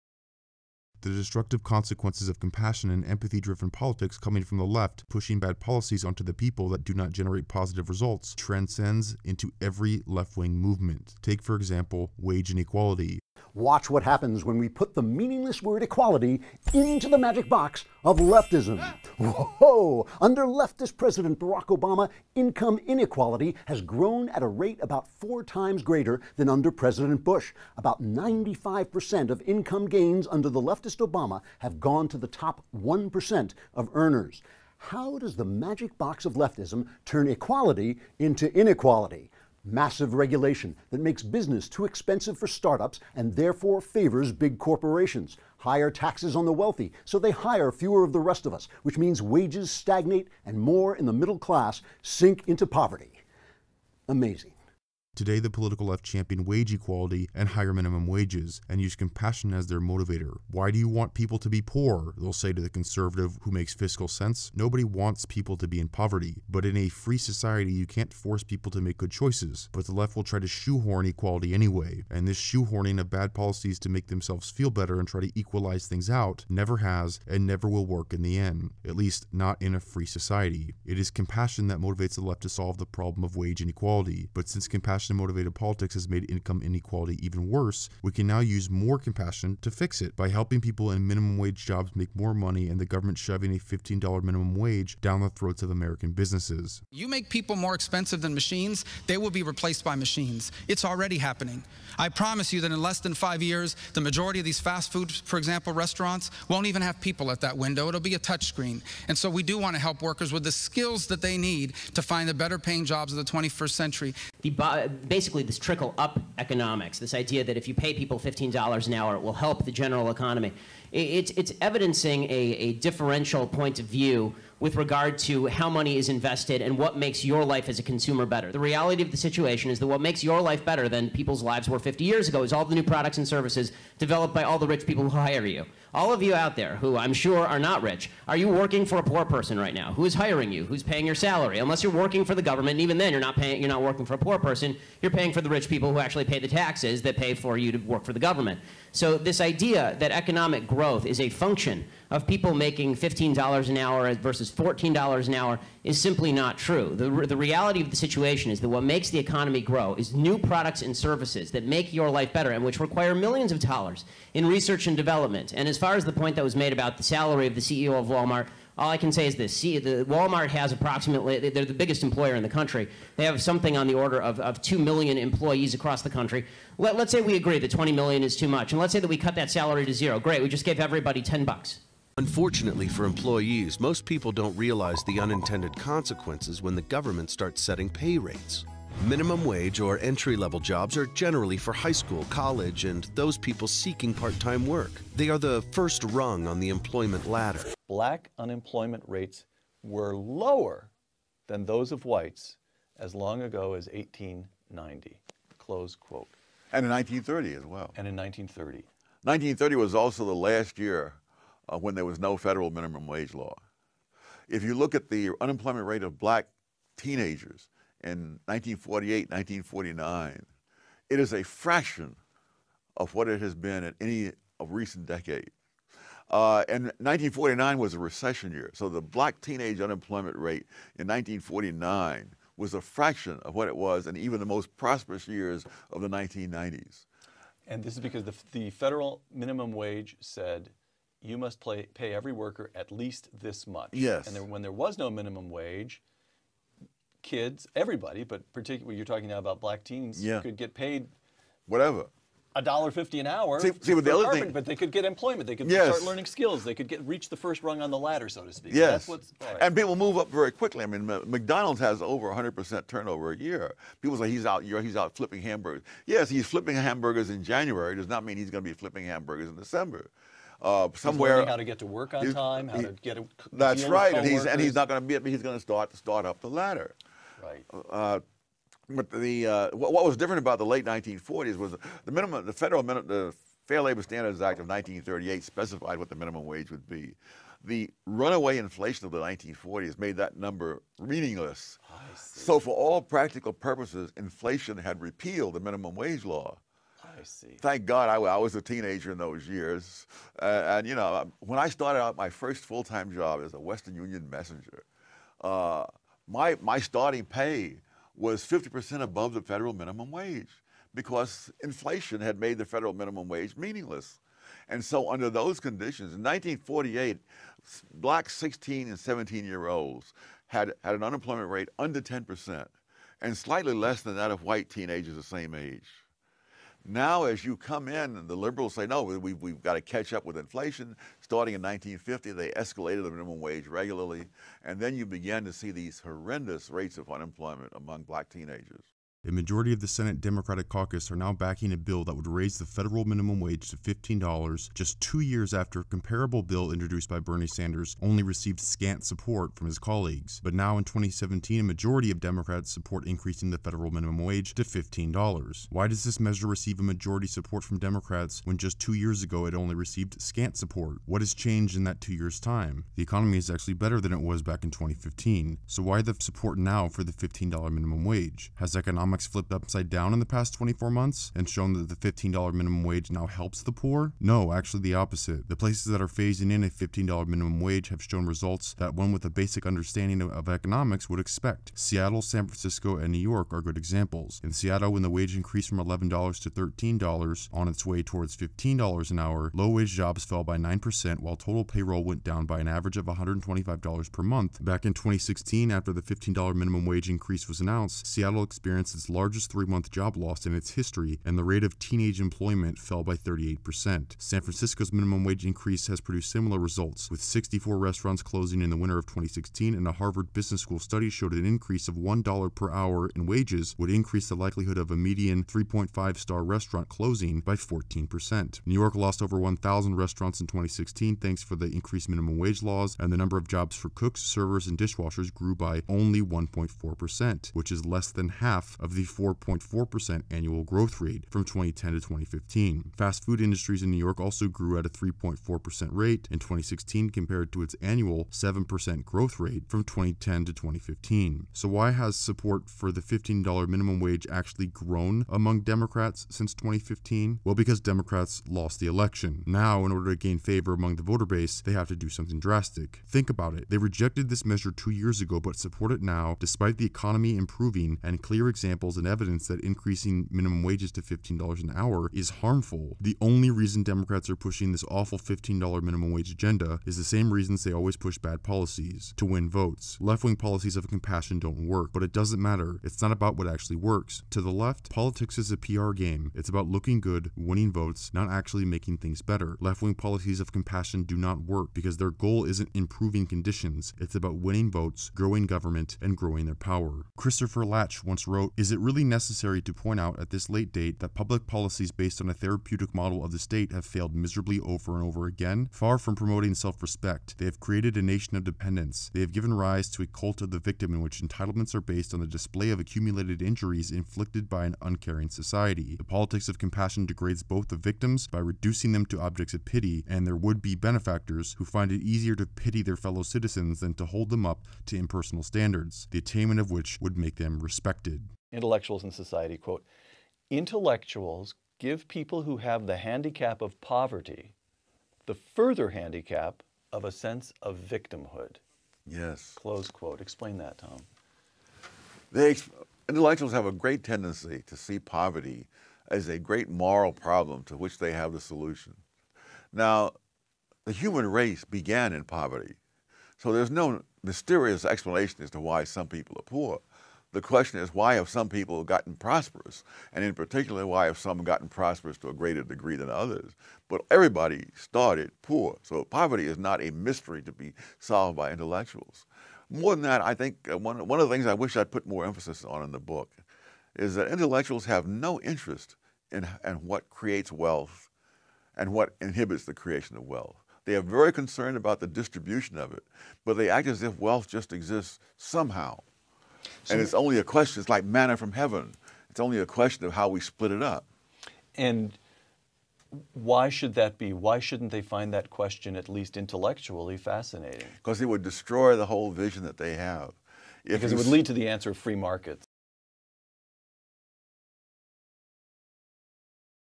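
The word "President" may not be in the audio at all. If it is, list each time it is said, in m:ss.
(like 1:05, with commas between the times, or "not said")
0:20, 0:26.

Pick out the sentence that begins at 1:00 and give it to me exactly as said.
Why do you want people to be poor?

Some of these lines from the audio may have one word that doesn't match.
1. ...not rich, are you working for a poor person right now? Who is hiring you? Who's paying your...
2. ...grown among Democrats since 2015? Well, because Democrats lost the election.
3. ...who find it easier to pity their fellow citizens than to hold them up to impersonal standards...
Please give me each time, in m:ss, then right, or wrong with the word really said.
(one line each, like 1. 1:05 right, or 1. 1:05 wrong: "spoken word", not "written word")
1. 2:17 right
2. 7:24 right
3. 8:31 right.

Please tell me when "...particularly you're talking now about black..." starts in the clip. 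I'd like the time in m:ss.
4:08.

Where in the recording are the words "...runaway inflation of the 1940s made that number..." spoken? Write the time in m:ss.
4:48.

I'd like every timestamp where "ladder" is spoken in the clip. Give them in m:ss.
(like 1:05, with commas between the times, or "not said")
3:17, 4:17, 4:36.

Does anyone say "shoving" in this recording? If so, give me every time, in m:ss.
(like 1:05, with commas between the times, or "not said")
1:33.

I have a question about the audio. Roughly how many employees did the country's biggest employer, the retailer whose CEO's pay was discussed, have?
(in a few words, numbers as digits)
2 million.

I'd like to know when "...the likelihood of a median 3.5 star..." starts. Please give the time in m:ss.
6:54.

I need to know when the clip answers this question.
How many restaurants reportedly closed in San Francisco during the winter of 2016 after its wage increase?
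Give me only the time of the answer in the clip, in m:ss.
6:47.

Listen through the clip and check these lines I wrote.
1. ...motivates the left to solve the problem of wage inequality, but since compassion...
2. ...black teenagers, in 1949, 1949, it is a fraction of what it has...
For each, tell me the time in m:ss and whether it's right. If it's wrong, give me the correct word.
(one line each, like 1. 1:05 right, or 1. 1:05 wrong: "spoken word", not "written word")
1. 1:21 right
2. 3:36 wrong: "1948", not "1949".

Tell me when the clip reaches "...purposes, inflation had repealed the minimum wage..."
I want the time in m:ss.
4:53.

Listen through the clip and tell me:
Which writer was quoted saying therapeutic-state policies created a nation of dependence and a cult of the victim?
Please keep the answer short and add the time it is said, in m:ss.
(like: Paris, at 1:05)
Christopher Lasch, at 8:07.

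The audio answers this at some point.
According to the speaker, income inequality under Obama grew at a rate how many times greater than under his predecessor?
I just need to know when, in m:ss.
0:25.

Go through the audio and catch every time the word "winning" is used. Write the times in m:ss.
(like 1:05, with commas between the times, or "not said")
7:57, 8:04.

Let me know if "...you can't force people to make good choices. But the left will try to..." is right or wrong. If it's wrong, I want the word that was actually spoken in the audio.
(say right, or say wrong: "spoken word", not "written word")
right.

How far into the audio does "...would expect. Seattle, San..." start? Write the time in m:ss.
6:21.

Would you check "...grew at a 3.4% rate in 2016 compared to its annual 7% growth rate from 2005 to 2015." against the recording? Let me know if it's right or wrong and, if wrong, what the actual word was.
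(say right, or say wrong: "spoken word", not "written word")
wrong: "2010", not "2005".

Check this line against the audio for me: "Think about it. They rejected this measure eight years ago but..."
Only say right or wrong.
wrong.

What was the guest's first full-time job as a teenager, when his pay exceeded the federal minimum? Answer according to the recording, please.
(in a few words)
Western Union messenger.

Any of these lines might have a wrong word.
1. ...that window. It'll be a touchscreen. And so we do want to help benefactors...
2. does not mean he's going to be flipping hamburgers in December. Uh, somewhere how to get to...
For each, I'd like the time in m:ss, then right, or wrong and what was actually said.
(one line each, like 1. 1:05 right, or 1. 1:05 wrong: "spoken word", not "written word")
1. 1:47 wrong: "workers", not "benefactors"
2. 4:27 right.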